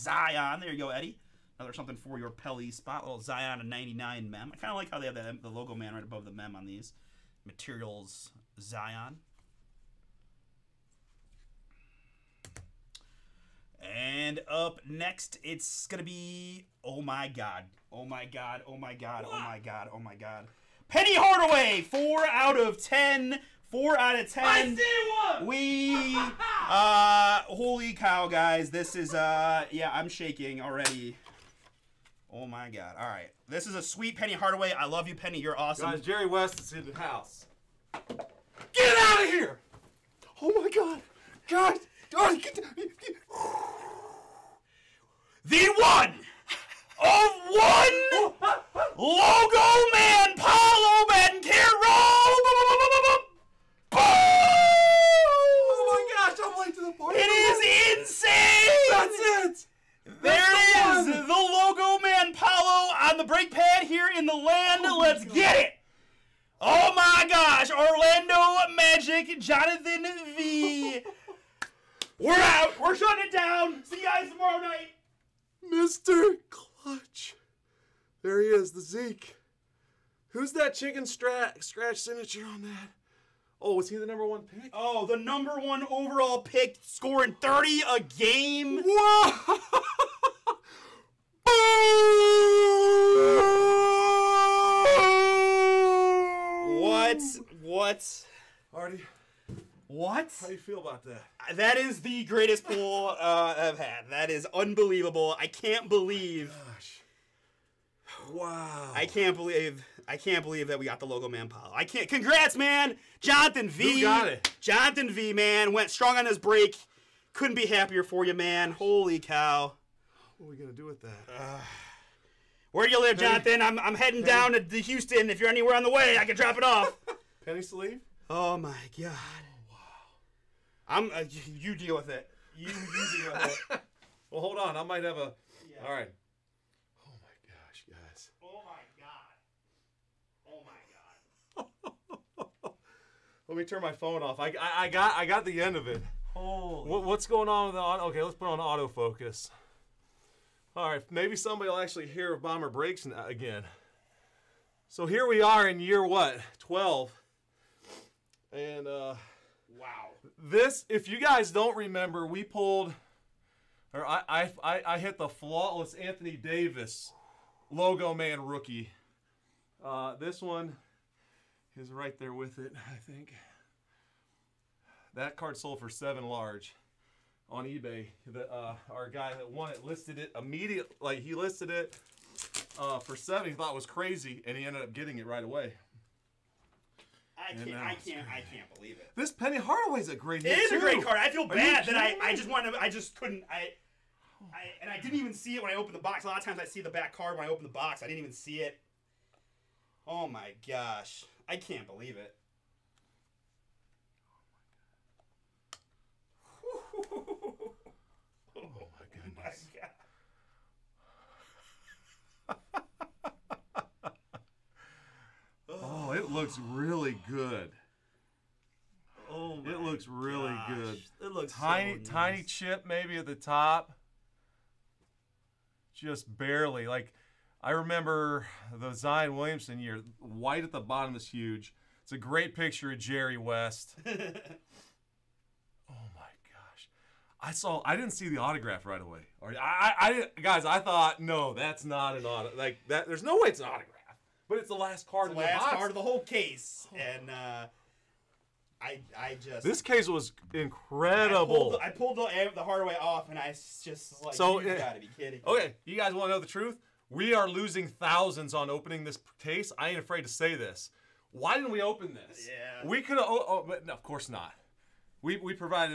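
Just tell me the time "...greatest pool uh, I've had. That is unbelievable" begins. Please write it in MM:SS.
01:42.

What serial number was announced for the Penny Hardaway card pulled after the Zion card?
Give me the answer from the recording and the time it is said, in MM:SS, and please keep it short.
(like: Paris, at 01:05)
4 out of 10, at 00:21.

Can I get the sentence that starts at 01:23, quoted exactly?
Oh, was he the number one pick?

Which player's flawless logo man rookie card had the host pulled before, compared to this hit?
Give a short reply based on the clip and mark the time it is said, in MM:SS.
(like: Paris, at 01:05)
Anthony Davis, at 02:45.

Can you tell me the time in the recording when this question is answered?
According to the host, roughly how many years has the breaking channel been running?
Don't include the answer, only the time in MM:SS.
02:36.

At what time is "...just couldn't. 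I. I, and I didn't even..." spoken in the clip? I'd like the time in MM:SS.
03:12.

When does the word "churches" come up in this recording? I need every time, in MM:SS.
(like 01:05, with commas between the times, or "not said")
not said.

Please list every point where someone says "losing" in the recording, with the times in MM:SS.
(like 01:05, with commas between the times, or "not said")
04:17.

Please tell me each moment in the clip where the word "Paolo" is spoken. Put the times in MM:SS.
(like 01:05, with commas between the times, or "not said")
00:50, 01:02.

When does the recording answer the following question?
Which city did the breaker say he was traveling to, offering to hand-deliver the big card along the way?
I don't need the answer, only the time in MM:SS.
02:04.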